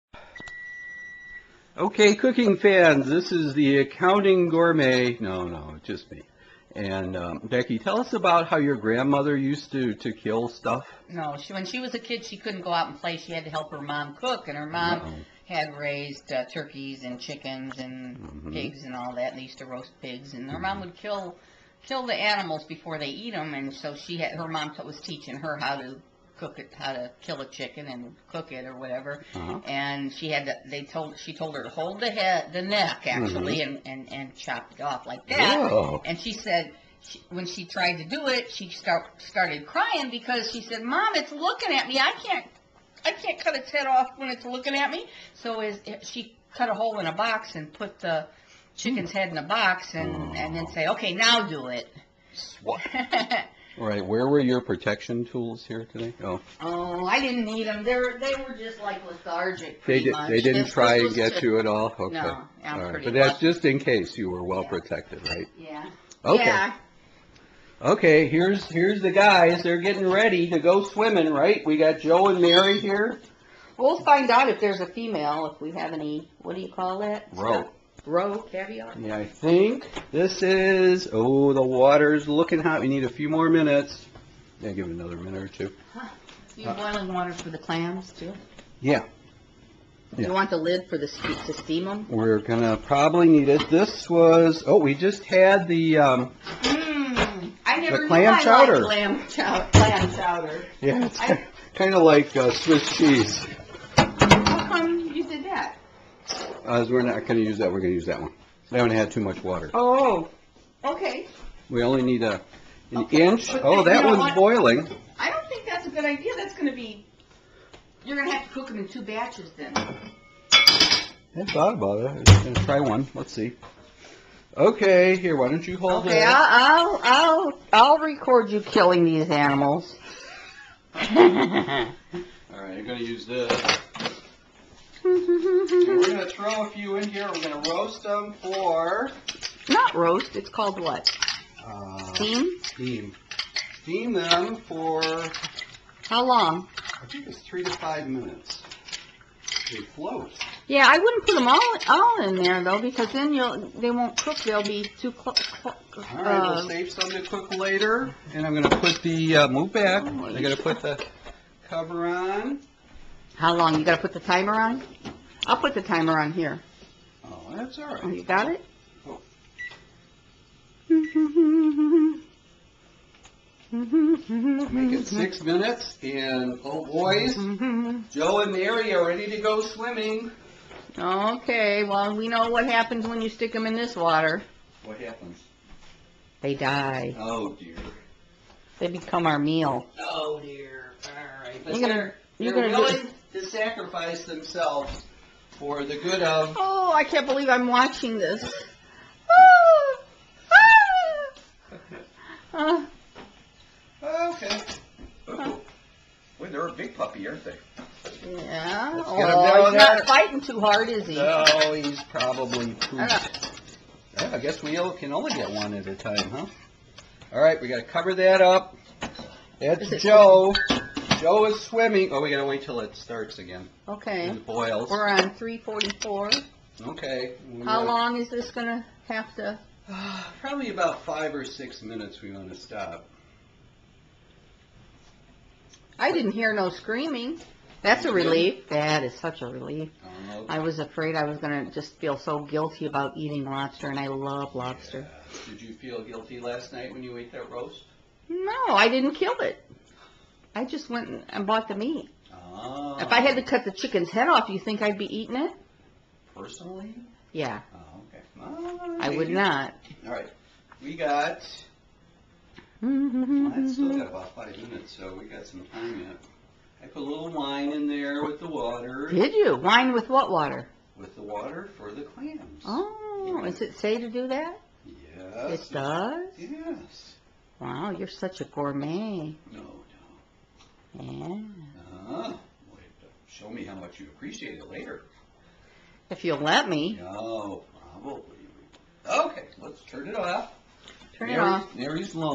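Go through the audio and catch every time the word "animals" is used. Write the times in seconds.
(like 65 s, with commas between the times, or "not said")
22 s, 129 s.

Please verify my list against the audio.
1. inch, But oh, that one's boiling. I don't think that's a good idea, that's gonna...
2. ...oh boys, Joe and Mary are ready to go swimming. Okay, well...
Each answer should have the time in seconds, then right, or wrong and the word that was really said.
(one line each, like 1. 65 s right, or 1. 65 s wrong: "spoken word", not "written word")
1. 113 s right
2. 176 s right.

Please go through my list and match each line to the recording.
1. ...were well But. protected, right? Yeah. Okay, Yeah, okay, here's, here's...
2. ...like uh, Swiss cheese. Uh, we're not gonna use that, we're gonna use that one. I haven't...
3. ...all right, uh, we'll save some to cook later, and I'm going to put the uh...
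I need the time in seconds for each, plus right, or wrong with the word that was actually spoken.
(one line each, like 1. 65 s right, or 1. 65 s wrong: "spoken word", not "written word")
1. 64 s wrong: "Yeah", not "But"
2. 102 s right
3. 155 s right.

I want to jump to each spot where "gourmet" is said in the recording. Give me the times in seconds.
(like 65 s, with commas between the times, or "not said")
4 s, 278 s.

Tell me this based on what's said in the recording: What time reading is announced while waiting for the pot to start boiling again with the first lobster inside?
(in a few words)
3:44.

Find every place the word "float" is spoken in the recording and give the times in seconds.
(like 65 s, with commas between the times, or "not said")
149 s.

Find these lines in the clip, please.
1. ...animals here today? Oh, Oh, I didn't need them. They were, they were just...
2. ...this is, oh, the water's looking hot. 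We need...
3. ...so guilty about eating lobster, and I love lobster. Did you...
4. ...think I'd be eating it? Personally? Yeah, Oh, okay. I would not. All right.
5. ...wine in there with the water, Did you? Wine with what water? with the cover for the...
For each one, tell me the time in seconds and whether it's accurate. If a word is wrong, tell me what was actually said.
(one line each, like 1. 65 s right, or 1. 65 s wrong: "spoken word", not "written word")
1. 55 s wrong: "tools", not "animals"
2. 80 s right
3. 242 s right
4. 254 s right
5. 267 s wrong: "water", not "cover".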